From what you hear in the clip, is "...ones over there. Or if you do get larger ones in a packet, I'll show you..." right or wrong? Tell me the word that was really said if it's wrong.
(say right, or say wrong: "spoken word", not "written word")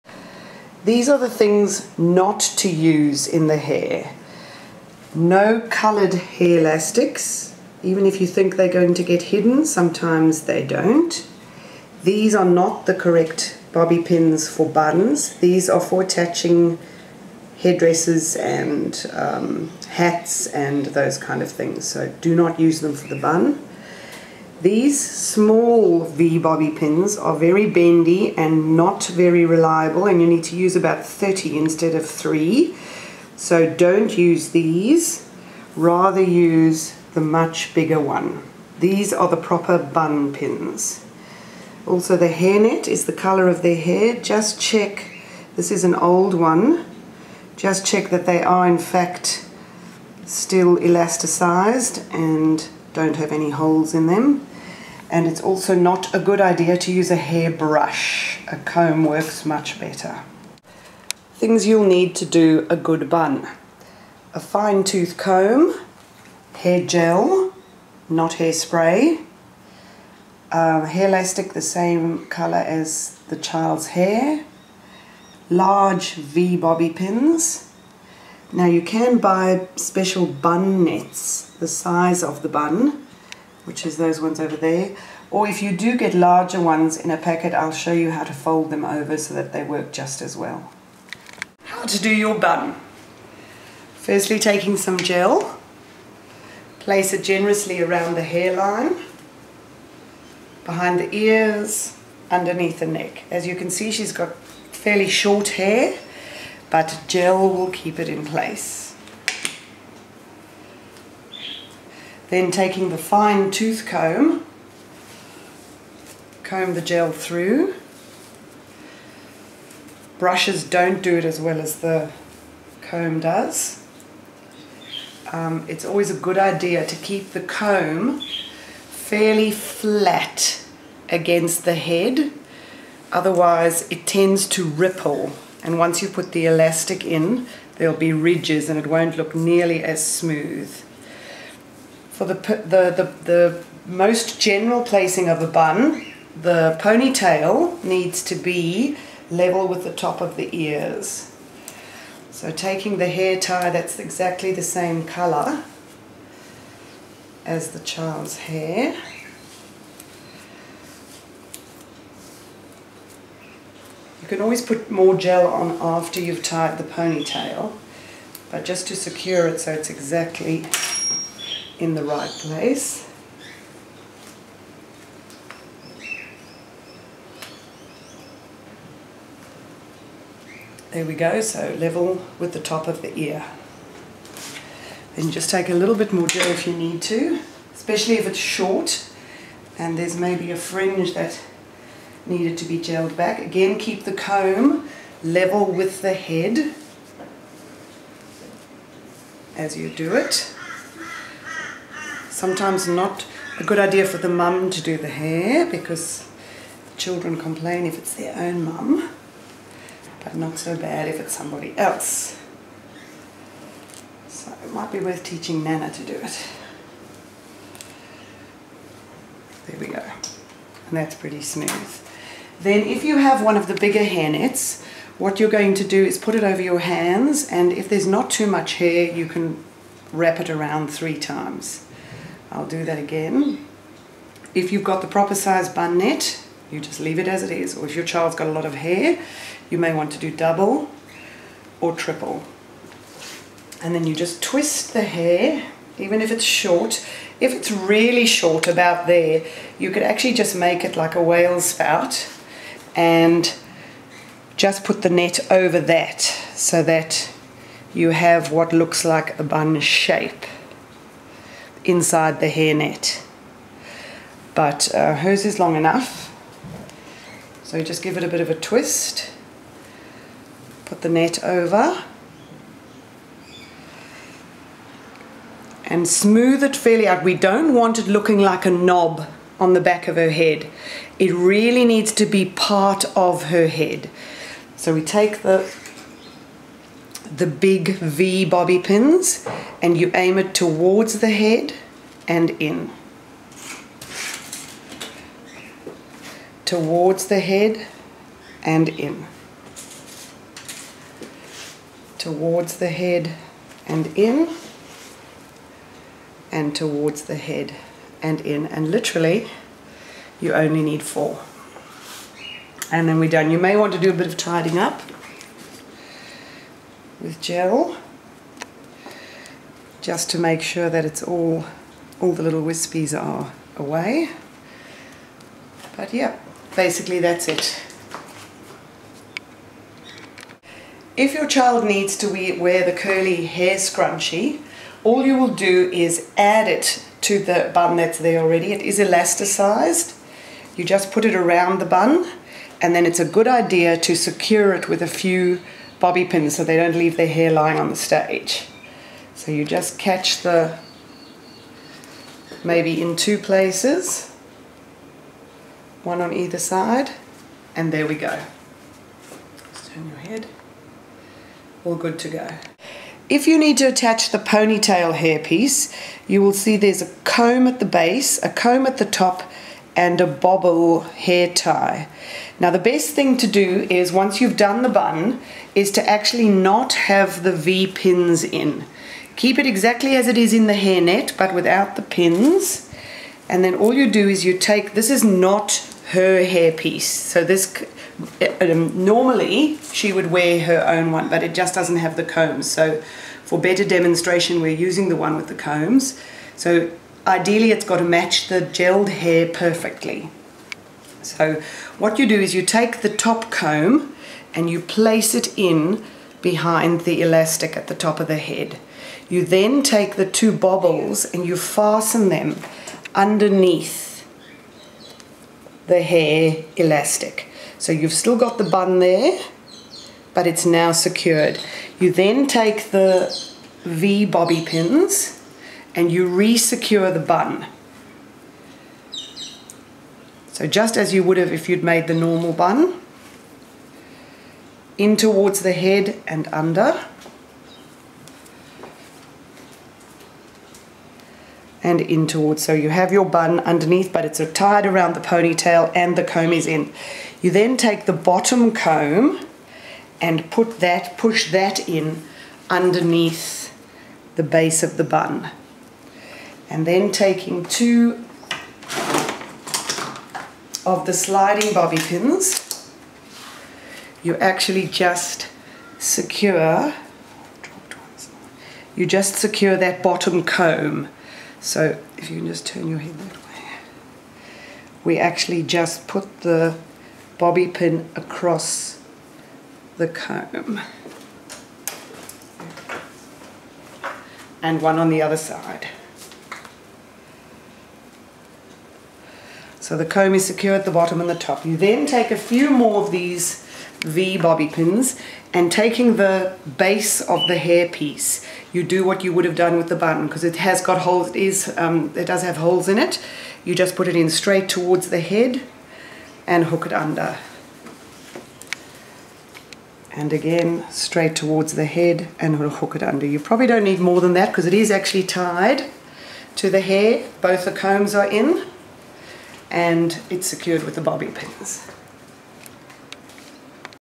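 right.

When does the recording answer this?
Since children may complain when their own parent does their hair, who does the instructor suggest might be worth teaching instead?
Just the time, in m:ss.
3:35.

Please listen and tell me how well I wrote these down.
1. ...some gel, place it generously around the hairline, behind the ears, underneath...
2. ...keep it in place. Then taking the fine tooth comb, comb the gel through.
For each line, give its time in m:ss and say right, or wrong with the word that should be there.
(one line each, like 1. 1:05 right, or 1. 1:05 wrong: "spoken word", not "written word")
1. 1:34 right
2. 1:47 right.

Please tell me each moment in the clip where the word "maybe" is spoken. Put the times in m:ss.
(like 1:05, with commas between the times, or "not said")
3:10, 5:52.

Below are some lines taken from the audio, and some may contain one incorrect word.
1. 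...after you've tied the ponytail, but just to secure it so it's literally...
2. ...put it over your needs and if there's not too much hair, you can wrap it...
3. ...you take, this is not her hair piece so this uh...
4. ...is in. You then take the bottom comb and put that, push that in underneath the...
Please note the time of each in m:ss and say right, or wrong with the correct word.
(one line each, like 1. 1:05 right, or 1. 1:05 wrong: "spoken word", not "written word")
1. 2:45 wrong: "exactly", not "literally"
2. 3:46 wrong: "hands", not "needs"
3. 6:24 right
4. 7:26 right.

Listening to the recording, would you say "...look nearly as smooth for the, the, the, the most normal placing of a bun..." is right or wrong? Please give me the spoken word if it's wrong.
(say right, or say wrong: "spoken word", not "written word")
wrong: "general", not "normal".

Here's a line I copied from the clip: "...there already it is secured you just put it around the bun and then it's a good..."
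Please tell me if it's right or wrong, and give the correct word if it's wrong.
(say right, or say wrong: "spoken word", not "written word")
wrong: "elasticized", not "secured".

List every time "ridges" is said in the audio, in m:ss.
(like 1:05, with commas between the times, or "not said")
2:18.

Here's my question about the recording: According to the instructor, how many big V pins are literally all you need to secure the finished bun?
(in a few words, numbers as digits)
4.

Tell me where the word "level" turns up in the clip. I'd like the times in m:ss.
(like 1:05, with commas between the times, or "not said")
2:29, 3:01, 3:15.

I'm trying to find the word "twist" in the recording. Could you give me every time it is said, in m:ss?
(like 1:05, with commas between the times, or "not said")
4:04, 4:28.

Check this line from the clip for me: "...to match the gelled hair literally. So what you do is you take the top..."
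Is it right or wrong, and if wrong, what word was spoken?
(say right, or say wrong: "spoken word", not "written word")
wrong: "perfectly", not "literally".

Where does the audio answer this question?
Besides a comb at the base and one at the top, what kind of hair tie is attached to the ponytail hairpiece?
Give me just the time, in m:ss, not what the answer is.
6:10.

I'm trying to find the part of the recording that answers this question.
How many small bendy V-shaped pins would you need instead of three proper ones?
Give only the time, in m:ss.
0:31.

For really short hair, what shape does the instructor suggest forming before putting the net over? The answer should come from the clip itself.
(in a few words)
whale spout.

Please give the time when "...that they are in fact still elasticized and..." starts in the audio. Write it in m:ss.
0:48.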